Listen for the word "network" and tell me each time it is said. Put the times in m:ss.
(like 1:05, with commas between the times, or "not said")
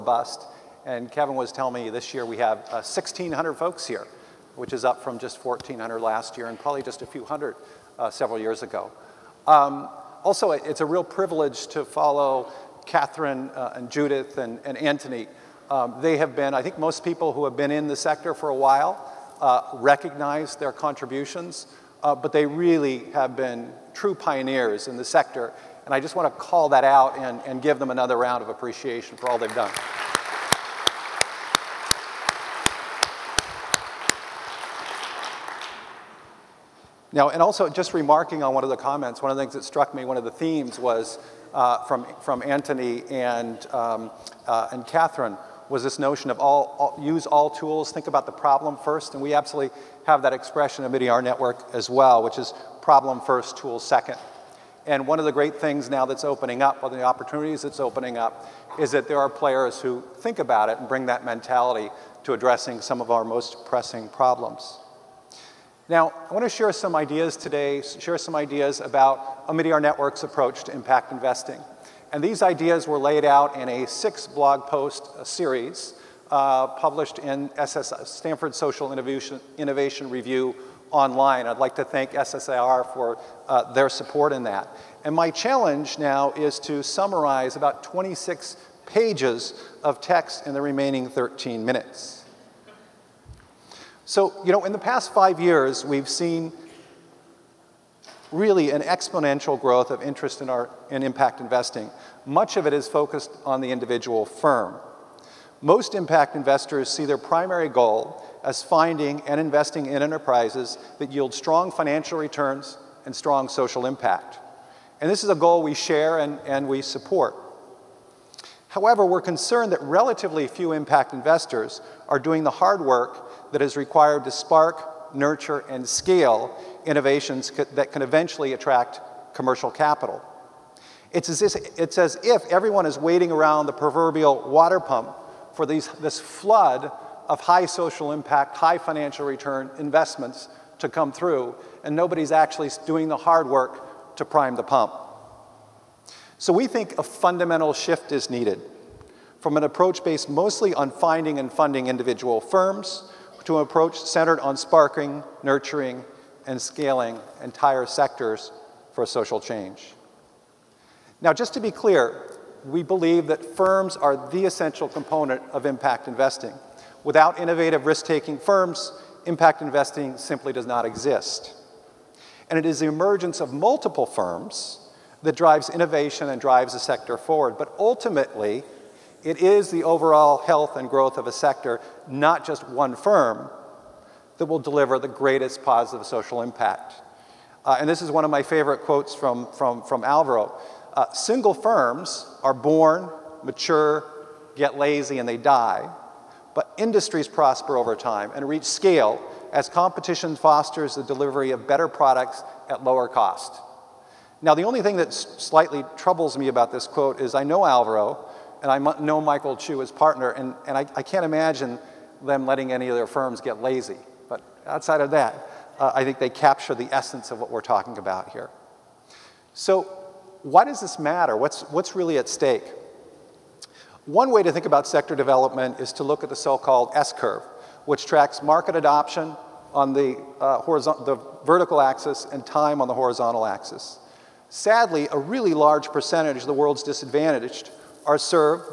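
0:51, 1:09.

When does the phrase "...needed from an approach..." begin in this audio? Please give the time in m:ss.
2:28.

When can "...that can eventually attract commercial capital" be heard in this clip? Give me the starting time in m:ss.
2:07.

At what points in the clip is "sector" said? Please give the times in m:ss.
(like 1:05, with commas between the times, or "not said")
0:17, 0:25, 2:37, 2:56, 3:01, 3:44.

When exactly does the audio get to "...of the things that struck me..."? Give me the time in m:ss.
0:39.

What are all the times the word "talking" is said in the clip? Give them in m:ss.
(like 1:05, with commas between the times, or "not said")
3:37.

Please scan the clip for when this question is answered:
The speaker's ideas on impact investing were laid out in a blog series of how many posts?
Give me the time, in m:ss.
1:13.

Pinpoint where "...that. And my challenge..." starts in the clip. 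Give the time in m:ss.
1:24.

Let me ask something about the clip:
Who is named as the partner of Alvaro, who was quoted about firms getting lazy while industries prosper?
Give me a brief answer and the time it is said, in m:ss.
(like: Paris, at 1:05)
Michael Chu, at 3:29.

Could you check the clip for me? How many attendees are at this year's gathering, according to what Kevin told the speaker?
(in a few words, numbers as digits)
1,600.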